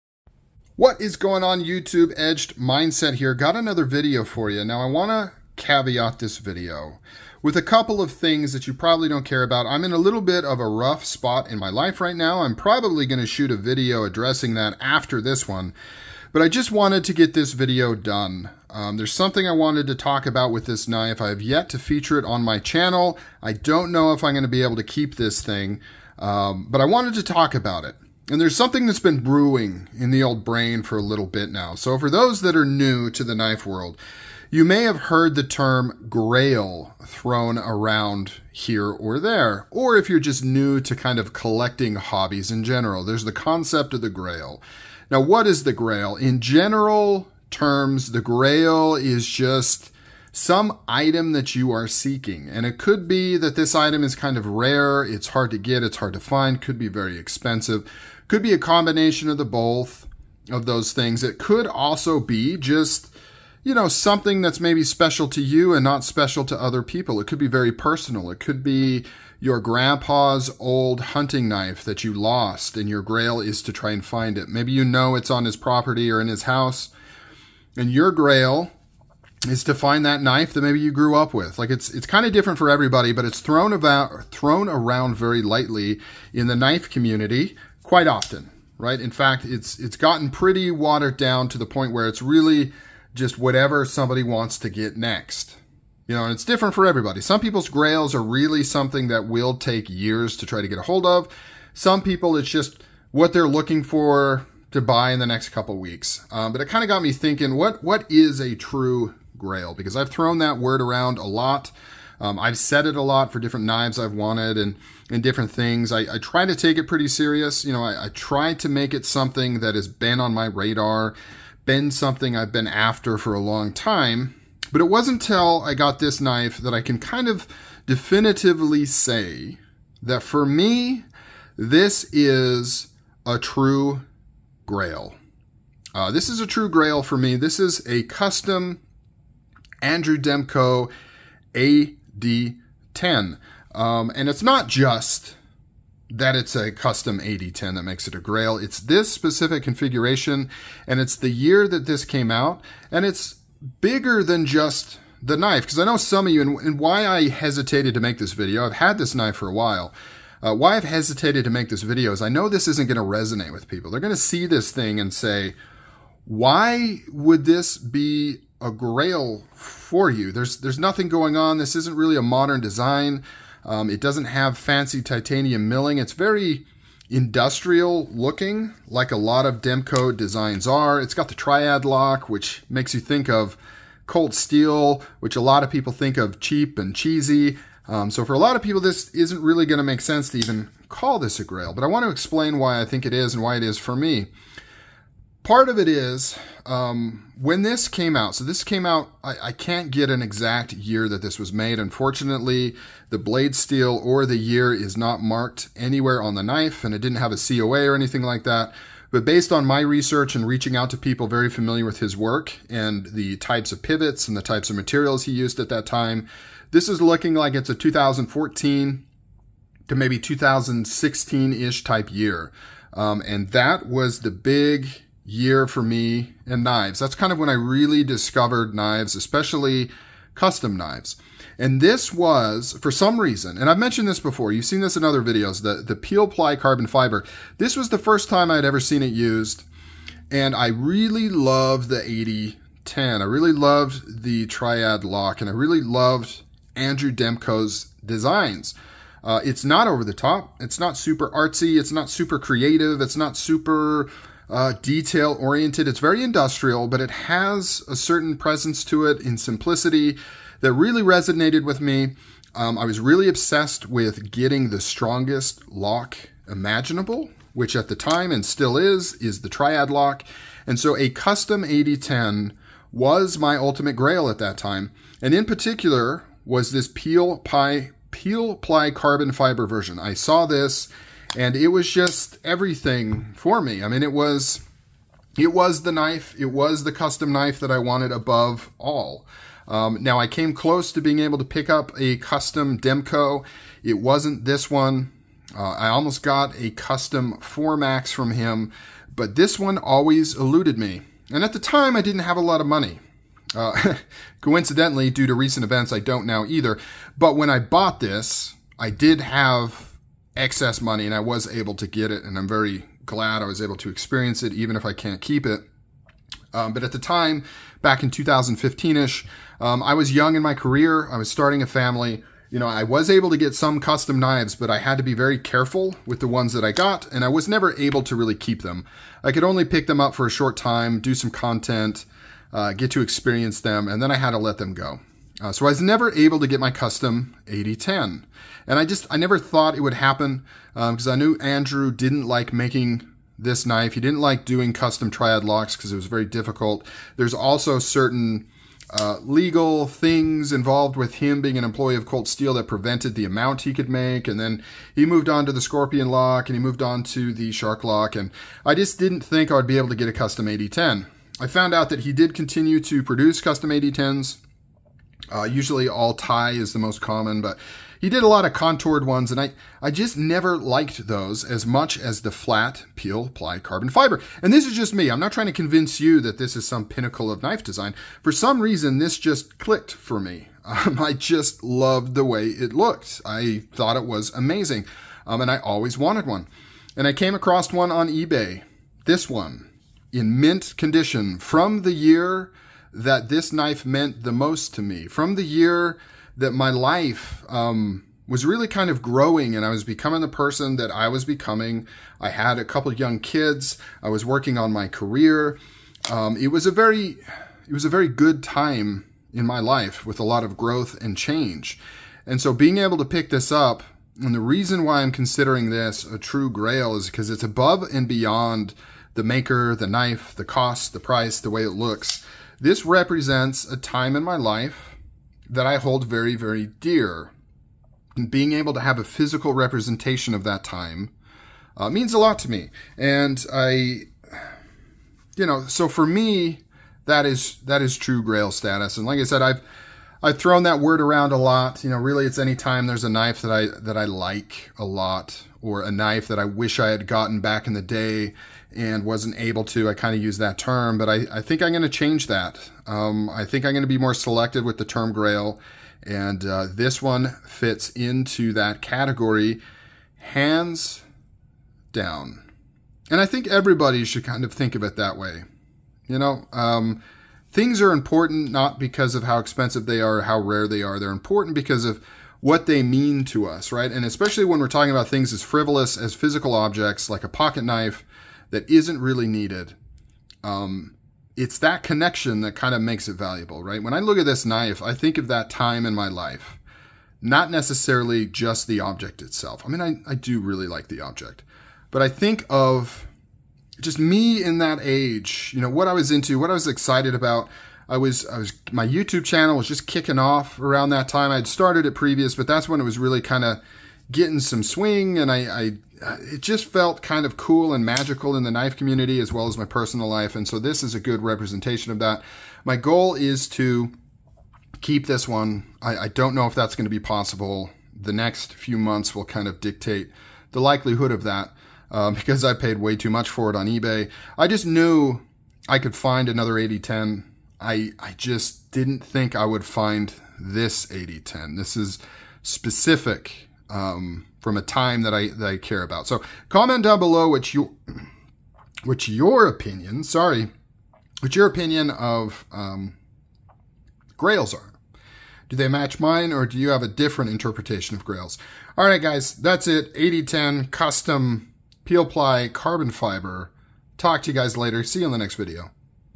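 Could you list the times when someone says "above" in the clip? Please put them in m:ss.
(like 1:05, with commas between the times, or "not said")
4:48, 6:57.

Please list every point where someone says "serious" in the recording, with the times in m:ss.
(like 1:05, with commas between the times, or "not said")
1:57.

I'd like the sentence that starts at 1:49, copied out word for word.
Because I've thrown that word around a lot.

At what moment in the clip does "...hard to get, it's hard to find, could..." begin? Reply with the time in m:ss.
0:55.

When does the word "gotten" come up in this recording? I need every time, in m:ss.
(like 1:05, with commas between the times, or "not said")
1:29, 7:27.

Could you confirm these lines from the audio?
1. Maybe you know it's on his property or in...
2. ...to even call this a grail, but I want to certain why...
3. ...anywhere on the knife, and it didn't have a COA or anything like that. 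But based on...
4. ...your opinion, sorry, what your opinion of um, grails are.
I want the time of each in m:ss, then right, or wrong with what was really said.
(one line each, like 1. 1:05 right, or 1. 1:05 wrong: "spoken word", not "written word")
1. 1:14 right
2. 3:10 wrong: "explain", not "certain"
3. 3:25 right
4. 8:59 right.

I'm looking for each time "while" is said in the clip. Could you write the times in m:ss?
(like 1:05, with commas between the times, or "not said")
2:39.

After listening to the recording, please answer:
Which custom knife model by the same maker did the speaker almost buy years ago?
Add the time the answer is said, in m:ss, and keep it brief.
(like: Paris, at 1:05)
4MAX, at 4:57.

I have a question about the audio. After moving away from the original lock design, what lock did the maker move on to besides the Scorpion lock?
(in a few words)
Shark lock.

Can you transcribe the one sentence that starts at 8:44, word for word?
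I just knew I could find another AD-10.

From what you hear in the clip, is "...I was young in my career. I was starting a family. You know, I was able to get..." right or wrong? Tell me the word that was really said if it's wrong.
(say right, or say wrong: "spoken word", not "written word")
right.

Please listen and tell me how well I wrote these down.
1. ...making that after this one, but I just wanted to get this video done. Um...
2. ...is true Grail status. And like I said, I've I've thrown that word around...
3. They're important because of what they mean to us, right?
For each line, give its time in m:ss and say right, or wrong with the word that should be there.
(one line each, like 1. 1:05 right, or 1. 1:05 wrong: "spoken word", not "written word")
1. 0:14 wrong: "addressing", not "making"
2. 7:17 right
3. 7:50 right.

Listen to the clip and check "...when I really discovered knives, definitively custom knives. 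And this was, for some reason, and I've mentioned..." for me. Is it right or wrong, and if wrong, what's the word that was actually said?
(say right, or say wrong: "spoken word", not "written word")
wrong: "especially", not "definitively".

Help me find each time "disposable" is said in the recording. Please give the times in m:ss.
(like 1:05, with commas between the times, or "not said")
not said.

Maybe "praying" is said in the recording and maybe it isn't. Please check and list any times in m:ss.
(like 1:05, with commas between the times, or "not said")
not said.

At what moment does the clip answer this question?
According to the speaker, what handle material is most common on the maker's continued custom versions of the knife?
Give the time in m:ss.
6:05.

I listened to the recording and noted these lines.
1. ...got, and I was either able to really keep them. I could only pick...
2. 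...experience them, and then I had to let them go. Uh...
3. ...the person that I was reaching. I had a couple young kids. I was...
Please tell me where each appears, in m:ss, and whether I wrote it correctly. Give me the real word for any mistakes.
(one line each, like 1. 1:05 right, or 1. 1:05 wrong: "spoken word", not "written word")
1. 5:26 wrong: "never", not "either"
2. 5:33 right
3. 6:40 wrong: "becoming", not "reaching".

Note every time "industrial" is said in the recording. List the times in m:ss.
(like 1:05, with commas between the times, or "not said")
2:57, 4:16.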